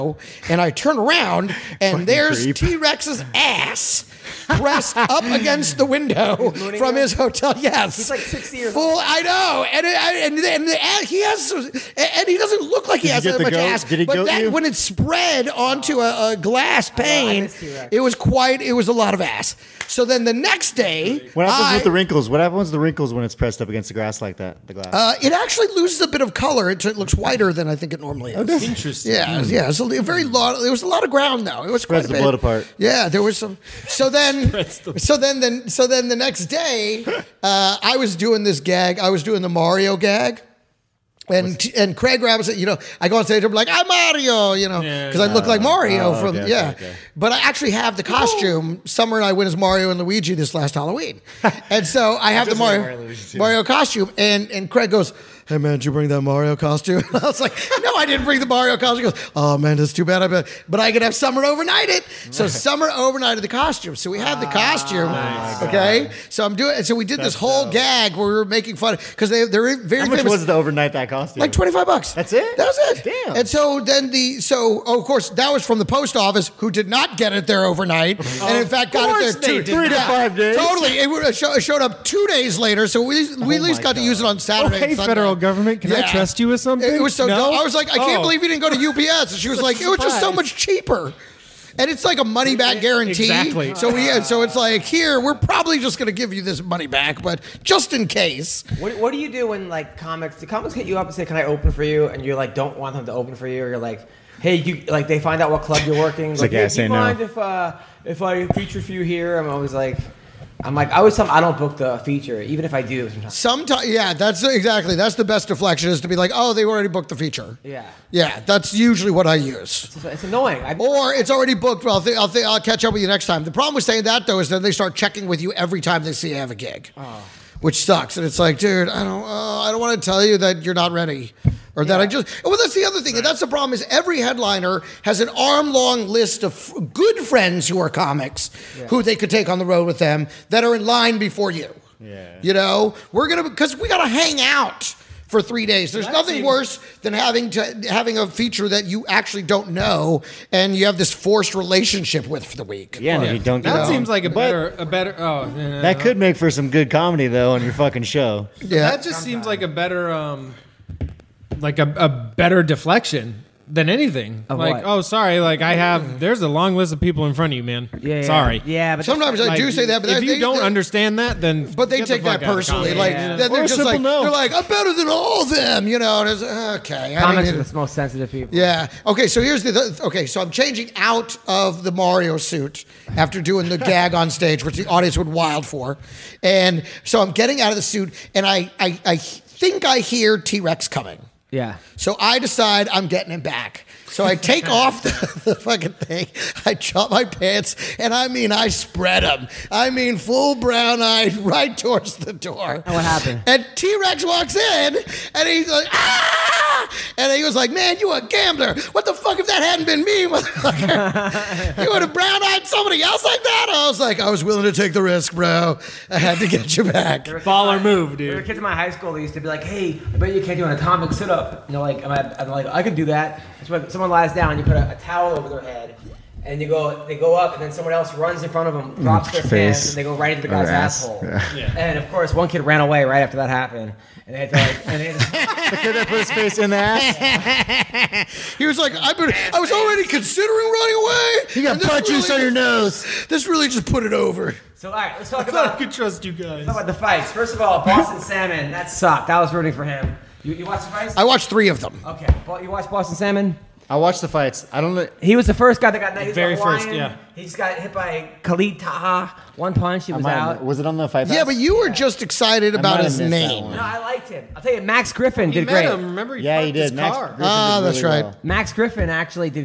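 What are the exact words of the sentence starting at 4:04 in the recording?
So all right, let's talk about.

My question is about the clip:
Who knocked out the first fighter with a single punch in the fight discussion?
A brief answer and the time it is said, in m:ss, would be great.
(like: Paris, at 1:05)
Khalid Taha, at 4:18.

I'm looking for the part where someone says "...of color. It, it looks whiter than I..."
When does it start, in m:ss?
0:26.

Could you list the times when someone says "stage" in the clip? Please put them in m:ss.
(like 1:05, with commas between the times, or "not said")
0:43, 3:04.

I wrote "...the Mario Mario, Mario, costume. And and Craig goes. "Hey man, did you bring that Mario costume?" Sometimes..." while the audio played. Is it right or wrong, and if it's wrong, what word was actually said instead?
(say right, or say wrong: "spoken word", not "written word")
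wrong: "And", not "Sometimes".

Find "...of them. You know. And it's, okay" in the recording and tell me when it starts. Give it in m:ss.
2:55.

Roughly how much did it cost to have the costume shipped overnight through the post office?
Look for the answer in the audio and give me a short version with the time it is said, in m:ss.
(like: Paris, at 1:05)
25 bucks, at 1:11.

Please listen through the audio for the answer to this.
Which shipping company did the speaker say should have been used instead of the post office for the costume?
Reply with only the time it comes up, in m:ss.
1:28.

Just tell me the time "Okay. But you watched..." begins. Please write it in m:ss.
4:12.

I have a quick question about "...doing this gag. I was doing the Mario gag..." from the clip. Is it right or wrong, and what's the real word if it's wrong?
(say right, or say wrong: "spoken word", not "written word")
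right.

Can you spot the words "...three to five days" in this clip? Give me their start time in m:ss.
1:19.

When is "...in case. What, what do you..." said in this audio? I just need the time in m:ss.
1:37.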